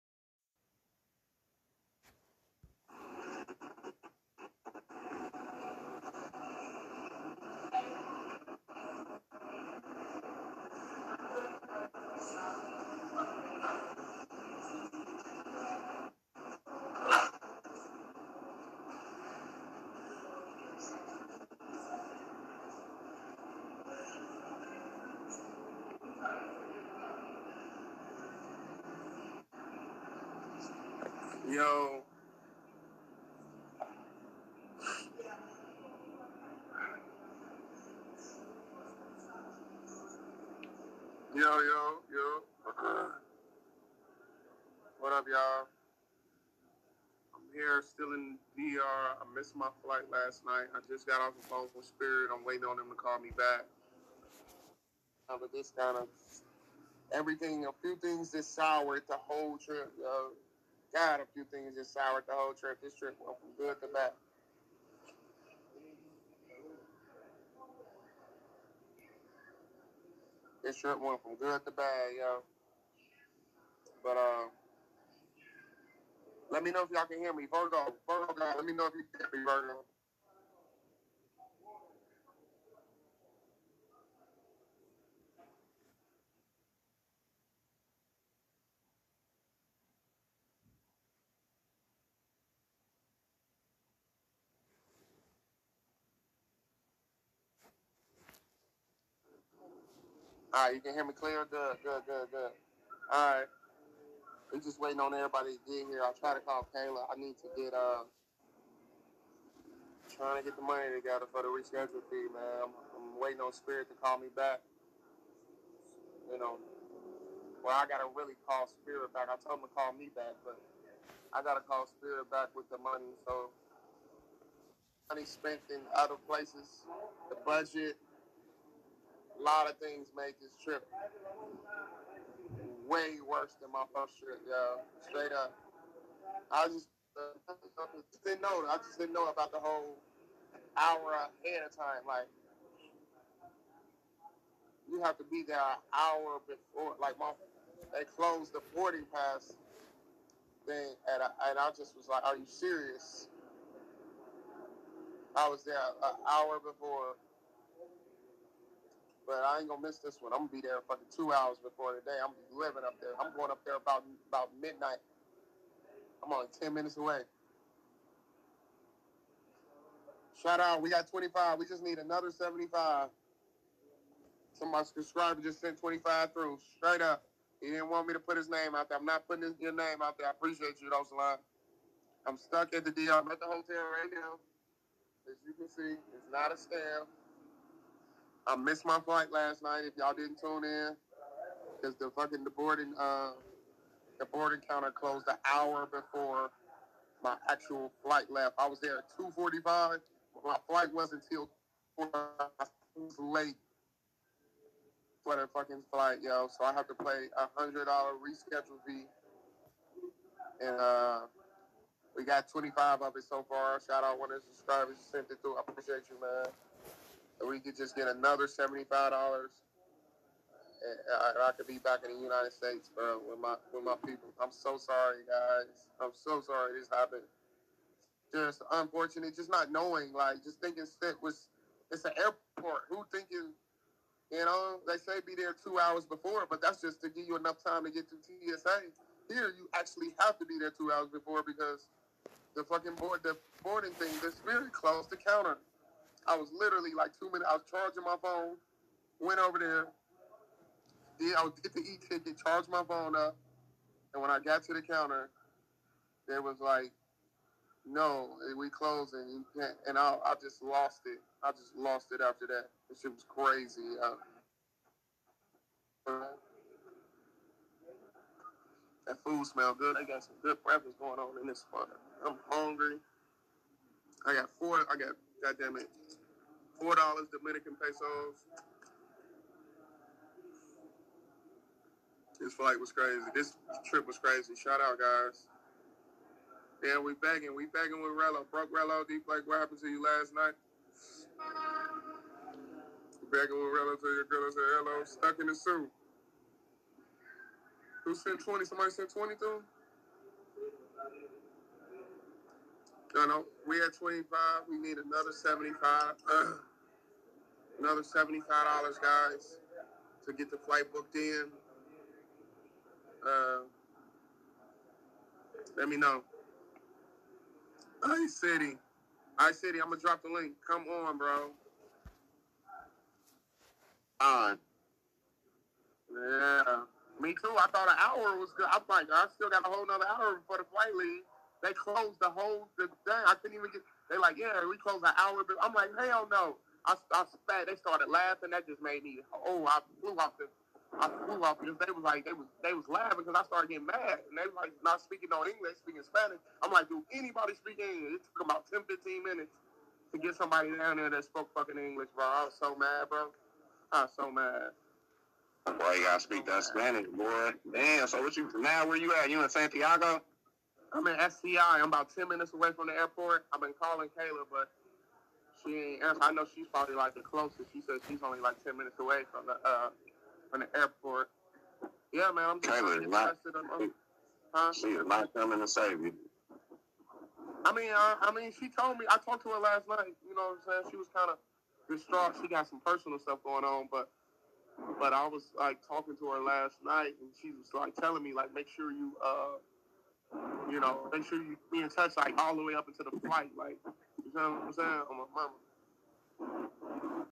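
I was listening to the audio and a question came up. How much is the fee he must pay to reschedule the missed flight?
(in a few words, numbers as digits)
$100.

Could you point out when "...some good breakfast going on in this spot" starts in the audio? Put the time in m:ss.
4:30.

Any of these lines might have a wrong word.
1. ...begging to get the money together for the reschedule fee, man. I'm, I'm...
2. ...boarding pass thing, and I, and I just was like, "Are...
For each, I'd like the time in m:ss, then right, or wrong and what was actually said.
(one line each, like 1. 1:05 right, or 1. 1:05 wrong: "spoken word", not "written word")
1. 1:50 wrong: "trying", not "begging"
2. 2:28 right.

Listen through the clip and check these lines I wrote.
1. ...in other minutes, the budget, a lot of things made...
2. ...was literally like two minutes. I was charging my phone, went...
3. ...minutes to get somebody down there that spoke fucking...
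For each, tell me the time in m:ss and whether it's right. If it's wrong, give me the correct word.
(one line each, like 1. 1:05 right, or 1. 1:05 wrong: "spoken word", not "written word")
1. 2:05 wrong: "places", not "minutes"
2. 4:06 right
3. 5:49 right.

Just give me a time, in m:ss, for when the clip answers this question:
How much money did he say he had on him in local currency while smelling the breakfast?
4:36.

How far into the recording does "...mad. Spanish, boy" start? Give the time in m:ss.
5:56.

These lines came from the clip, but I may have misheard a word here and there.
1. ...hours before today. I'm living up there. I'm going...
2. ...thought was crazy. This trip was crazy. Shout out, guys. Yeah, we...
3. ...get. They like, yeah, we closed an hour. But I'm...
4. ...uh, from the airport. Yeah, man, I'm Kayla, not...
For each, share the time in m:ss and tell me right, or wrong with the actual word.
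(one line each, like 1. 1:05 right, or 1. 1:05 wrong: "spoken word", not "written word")
1. 2:41 right
2. 4:42 wrong: "flight", not "thought"
3. 5:33 right
4. 6:09 right.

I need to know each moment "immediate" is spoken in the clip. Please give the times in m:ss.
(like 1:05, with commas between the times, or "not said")
not said.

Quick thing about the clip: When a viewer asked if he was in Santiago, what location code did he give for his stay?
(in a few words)
SCI.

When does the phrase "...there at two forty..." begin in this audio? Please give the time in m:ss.
3:18.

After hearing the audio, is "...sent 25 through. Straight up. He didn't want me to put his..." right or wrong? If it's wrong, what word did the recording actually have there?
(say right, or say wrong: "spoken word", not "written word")
right.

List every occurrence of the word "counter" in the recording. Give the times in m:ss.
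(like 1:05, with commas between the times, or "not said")
3:14, 4:05, 4:14.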